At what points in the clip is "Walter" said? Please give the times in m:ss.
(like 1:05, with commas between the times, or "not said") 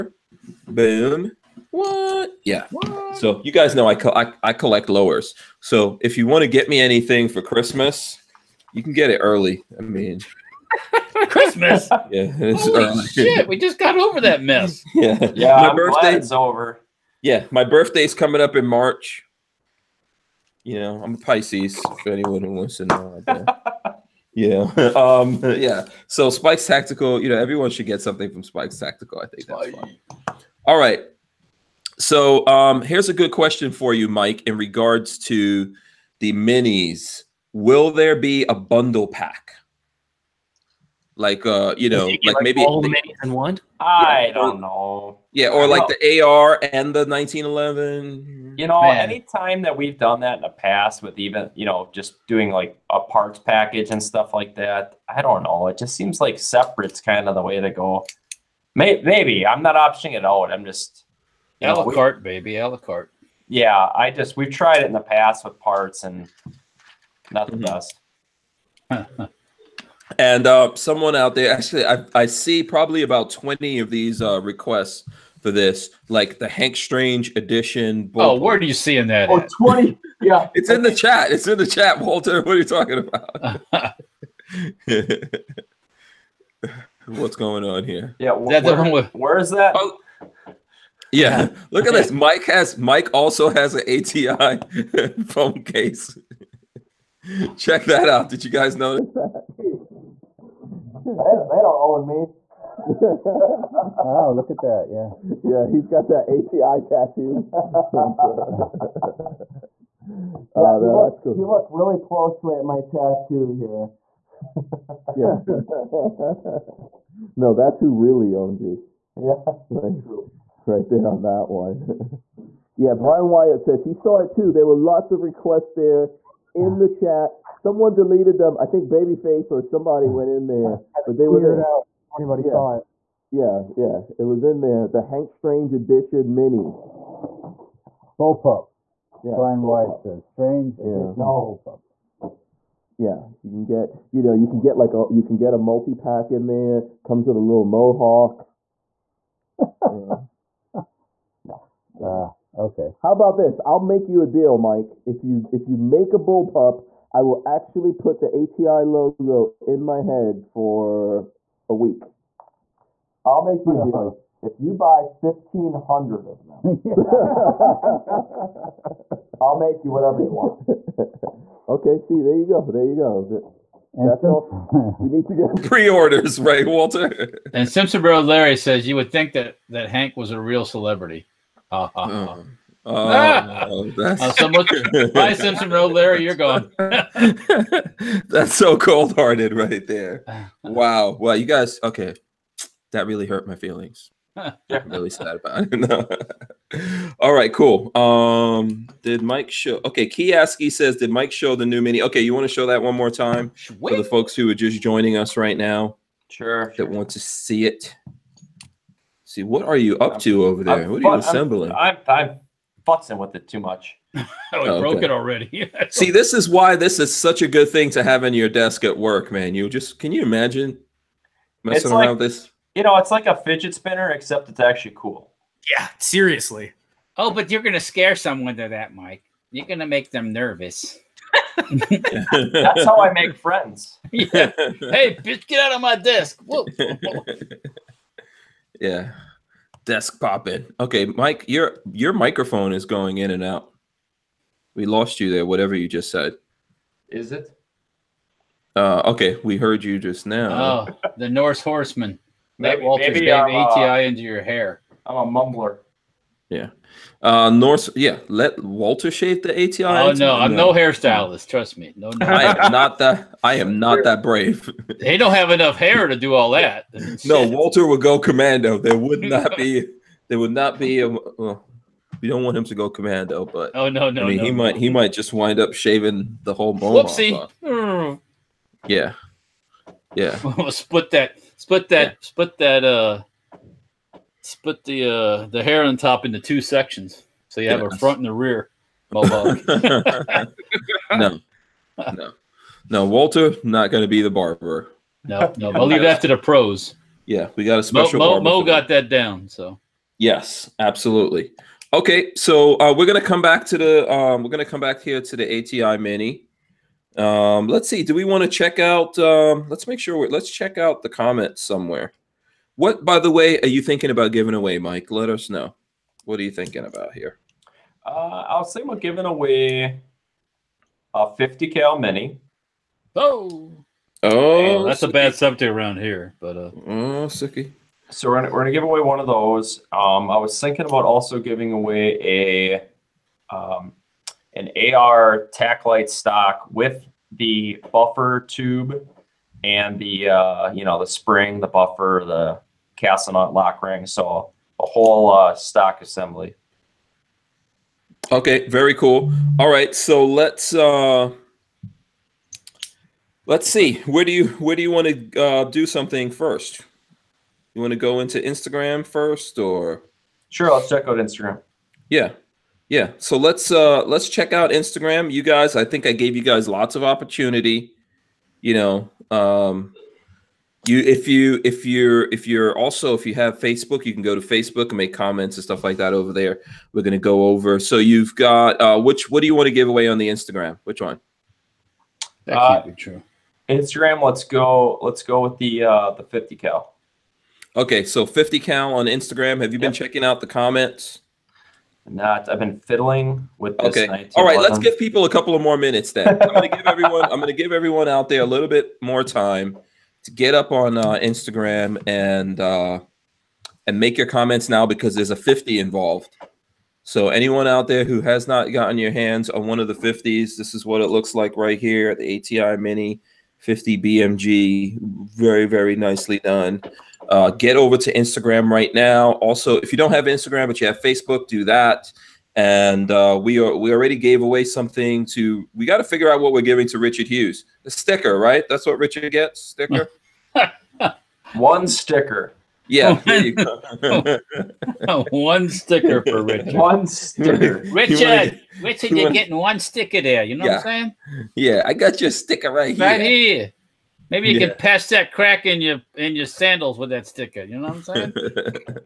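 1:22, 2:56, 4:12, 4:18, 4:27, 4:53.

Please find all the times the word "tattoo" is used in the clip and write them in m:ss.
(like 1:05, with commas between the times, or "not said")
1:46, 1:52.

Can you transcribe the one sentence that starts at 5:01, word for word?
Okay, so uh, we're gonna come back to the um, we're gonna come back here to the ATI Mini.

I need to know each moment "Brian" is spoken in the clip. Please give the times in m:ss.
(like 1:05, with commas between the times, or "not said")
2:02, 2:19.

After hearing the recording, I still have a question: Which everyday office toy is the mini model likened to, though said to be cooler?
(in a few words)
fidget spinner.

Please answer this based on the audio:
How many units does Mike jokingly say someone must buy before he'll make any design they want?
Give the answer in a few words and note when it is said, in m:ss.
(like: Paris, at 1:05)
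1500, at 2:45.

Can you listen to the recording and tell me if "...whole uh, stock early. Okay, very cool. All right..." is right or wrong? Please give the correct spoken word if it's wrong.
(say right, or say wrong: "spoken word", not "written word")
wrong: "assembly", not "early".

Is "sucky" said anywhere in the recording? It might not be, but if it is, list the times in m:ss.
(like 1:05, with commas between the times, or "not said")
5:27.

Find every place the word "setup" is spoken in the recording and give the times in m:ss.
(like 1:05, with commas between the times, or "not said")
not said.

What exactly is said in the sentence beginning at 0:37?
Will there be a bundle pack?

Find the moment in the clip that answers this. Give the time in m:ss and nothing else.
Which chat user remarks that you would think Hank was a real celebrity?
2:57.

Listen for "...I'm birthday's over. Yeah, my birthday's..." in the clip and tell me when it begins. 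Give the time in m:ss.
0:15.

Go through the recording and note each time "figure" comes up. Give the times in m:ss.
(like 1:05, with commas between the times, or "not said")
7:06.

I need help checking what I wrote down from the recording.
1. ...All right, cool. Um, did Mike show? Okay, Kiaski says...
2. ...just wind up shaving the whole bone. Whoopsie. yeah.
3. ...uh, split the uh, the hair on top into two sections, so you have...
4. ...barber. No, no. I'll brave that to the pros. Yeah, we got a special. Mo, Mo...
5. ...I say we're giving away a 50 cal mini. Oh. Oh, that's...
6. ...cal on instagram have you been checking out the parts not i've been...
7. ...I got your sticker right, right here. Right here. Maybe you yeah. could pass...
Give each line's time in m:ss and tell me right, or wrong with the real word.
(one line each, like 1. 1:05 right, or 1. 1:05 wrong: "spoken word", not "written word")
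1. 3:17 right
2. 4:35 right
3. 4:42 right
4. 4:54 wrong: "leave", not "brave"
5. 5:18 right
6. 6:28 wrong: "comments", not "parts"
7. 7:21 right.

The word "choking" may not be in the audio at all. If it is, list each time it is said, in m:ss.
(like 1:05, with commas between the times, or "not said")
not said.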